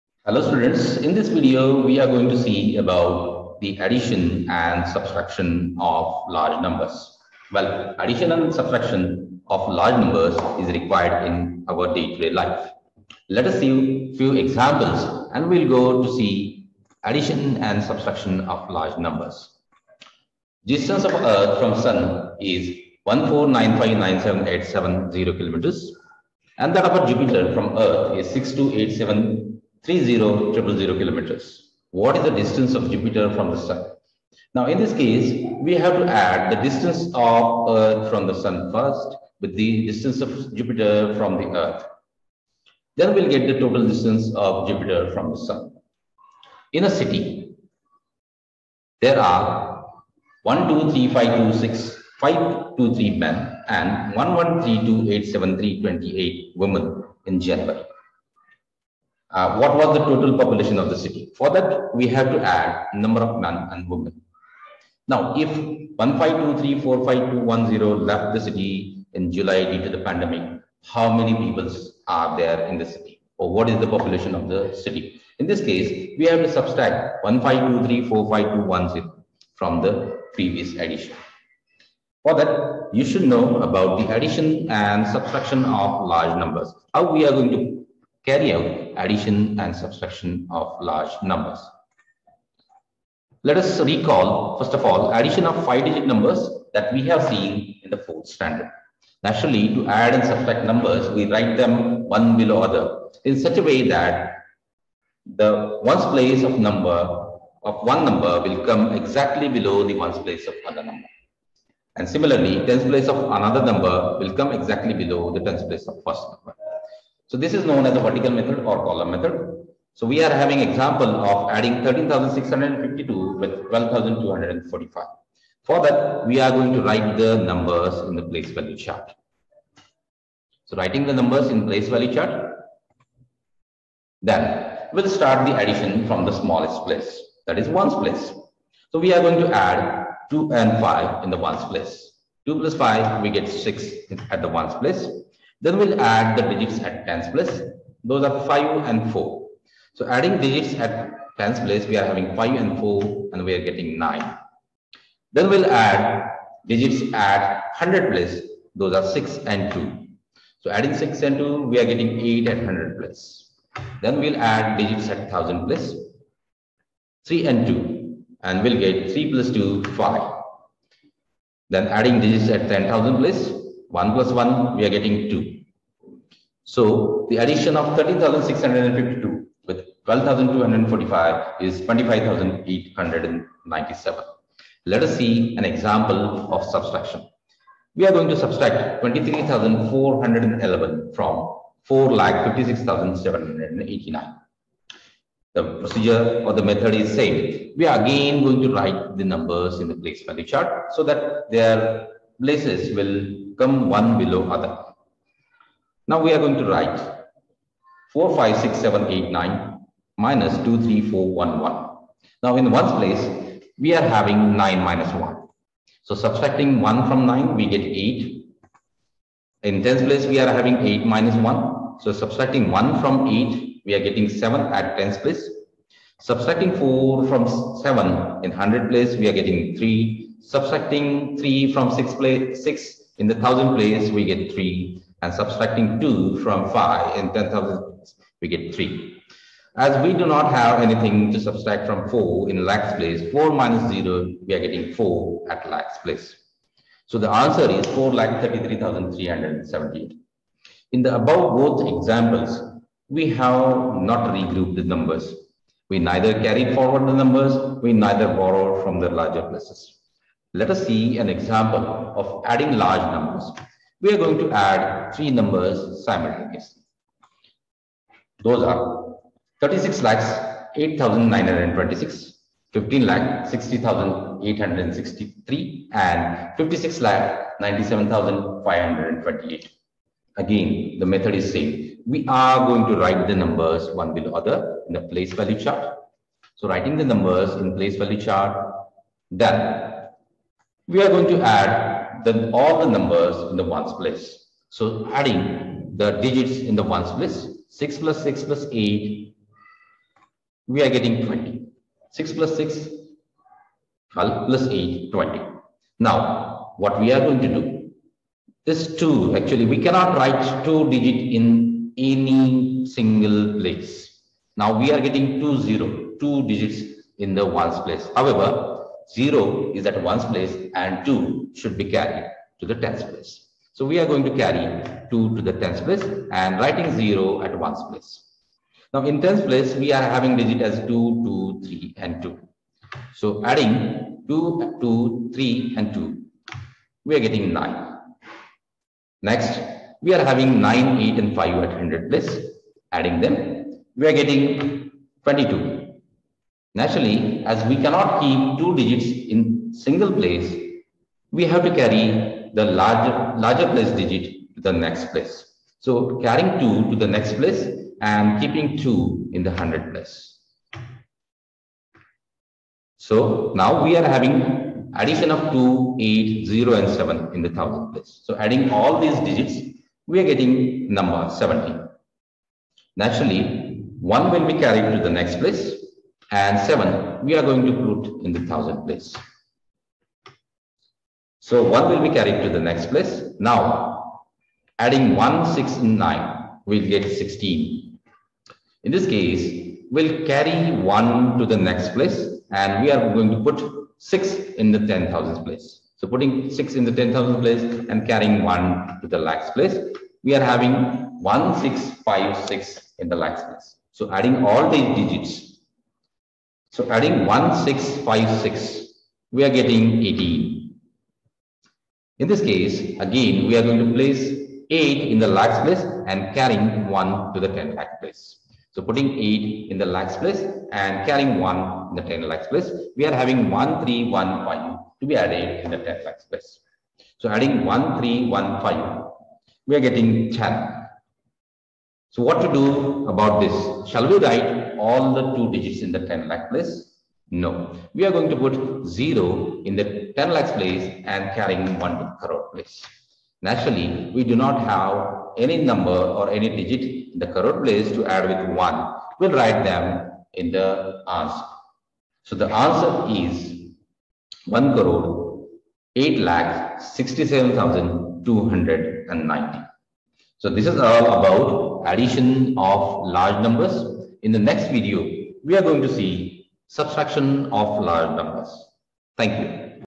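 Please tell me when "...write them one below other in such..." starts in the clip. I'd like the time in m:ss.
1:41.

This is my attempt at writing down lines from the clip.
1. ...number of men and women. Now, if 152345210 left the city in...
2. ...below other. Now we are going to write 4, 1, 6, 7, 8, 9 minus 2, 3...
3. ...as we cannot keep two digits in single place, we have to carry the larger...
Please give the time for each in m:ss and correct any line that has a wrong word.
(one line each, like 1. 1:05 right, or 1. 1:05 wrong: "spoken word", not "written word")
1. 1:02 right
2. 3:24 wrong: "5", not "1"
3. 5:47 right.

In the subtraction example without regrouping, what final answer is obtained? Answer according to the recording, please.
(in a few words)
433,378.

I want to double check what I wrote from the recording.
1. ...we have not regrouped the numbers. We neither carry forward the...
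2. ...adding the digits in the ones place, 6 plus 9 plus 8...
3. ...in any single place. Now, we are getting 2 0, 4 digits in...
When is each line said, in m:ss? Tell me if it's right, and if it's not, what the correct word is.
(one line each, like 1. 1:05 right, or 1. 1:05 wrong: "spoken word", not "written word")
1. 4:13 right
2. 4:55 wrong: "6", not "9"
3. 5:11 wrong: "2", not "4".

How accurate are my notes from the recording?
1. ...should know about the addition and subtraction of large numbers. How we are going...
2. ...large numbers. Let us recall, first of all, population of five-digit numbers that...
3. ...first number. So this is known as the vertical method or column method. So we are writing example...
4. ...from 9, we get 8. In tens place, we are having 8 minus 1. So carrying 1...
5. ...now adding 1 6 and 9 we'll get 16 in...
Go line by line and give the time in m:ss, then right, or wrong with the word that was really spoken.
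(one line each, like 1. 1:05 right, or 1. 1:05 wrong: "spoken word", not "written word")
1. 1:23 right
2. 1:30 wrong: "addition", not "population"
3. 1:56 wrong: "having", not "writing"
4. 3:37 wrong: "subtracting", not "carrying"
5. 6:23 right.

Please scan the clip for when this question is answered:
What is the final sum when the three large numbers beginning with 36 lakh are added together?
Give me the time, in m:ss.
7:34.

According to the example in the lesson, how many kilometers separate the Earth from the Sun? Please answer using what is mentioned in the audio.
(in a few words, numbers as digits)
149597870.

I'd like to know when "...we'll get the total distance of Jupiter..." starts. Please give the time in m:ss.
0:43.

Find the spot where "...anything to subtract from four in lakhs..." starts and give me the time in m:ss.
4:00.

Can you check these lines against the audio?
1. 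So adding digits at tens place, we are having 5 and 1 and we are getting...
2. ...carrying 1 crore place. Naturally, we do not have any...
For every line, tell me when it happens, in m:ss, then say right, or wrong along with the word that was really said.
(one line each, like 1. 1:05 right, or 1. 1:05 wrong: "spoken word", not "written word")
1. 2:29 wrong: "4", not "1"
2. 7:21 right.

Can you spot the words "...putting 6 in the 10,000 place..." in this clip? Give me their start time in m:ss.
6:36.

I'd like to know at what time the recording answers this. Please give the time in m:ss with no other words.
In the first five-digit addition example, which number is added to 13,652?
2:03.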